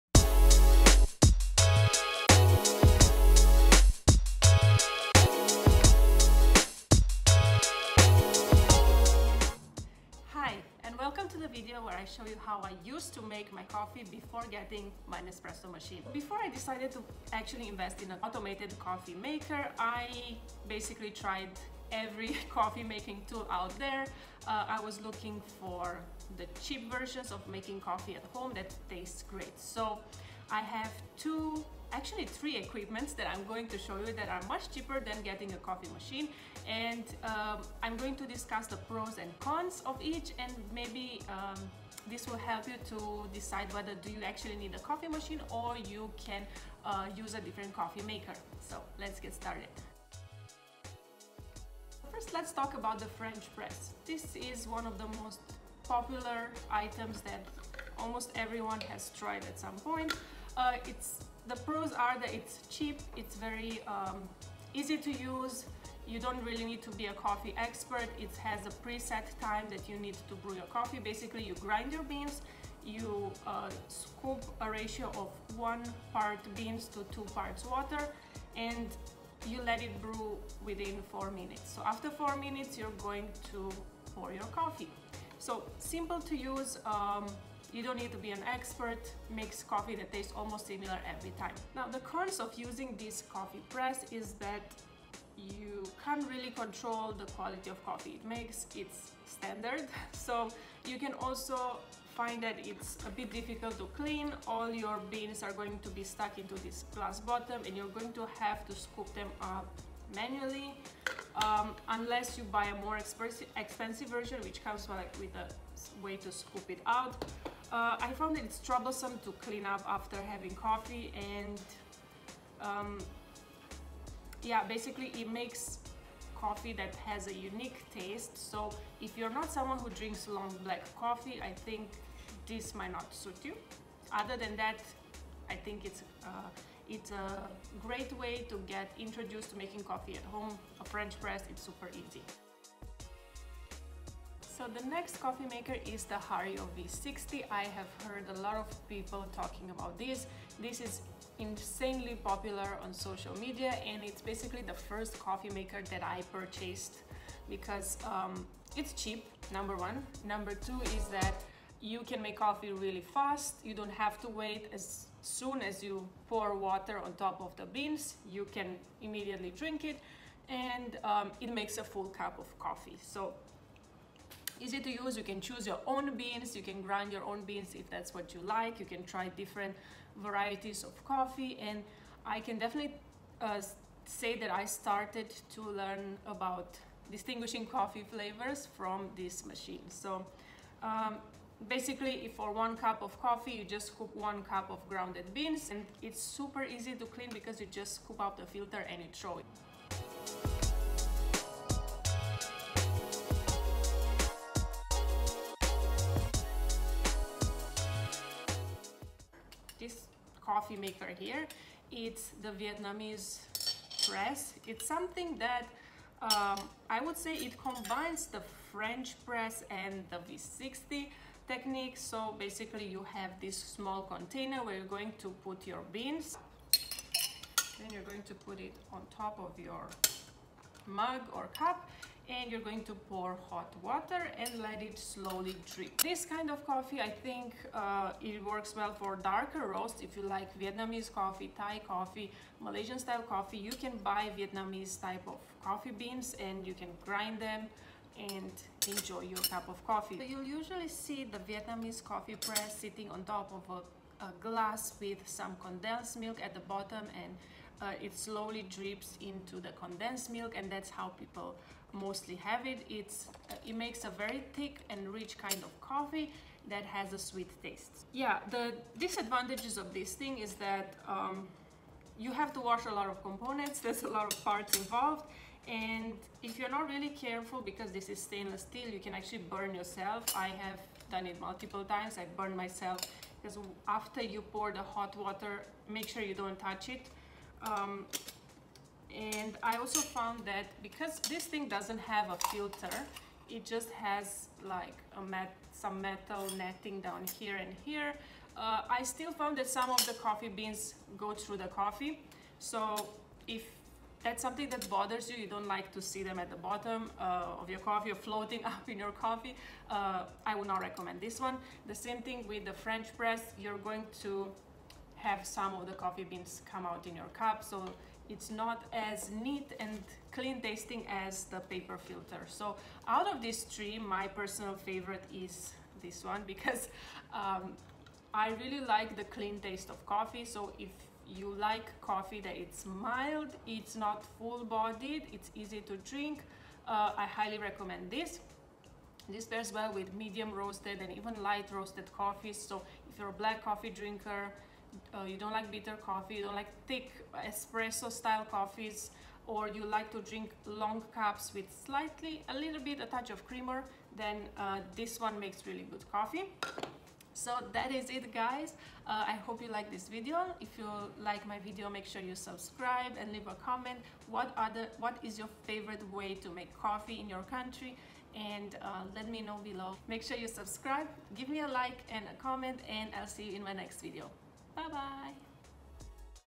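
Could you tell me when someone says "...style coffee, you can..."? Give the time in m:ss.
4:02.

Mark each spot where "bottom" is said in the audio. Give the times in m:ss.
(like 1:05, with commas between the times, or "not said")
1:47, 4:16, 5:06.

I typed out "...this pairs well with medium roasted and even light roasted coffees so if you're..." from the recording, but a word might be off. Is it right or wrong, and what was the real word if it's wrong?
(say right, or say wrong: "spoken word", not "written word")
right.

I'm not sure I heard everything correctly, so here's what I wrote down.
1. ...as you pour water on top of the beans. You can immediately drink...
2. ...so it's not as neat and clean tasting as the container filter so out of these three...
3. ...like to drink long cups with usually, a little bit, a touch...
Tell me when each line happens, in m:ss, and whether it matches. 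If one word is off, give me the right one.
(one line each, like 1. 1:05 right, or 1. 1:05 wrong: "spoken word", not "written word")
1. 2:45 right
2. 5:17 wrong: "paper", not "container"
3. 5:49 wrong: "slightly", not "usually".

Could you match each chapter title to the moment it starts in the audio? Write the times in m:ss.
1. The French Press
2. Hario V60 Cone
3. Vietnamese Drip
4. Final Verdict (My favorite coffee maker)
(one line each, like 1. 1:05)
1. 0:51
2. 2:23
3. 3:27
4. 5:15.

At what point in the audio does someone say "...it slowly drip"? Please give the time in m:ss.
3:54.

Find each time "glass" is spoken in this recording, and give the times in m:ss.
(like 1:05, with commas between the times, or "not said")
1:46, 4:14.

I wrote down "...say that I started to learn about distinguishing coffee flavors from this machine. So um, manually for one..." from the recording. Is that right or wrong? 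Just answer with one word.
wrong.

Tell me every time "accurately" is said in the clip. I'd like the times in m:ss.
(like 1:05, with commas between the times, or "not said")
not said.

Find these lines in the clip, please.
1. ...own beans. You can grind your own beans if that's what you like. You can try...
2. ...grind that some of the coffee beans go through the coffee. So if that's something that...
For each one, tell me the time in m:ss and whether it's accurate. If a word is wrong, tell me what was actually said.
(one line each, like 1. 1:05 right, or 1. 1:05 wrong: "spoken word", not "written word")
1. 2:55 right
2. 4:59 wrong: "found", not "grind".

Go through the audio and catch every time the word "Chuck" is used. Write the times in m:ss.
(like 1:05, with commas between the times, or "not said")
not said.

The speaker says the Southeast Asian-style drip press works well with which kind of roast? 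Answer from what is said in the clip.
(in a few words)
darker roast.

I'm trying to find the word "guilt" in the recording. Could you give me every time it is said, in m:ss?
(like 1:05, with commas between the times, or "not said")
not said.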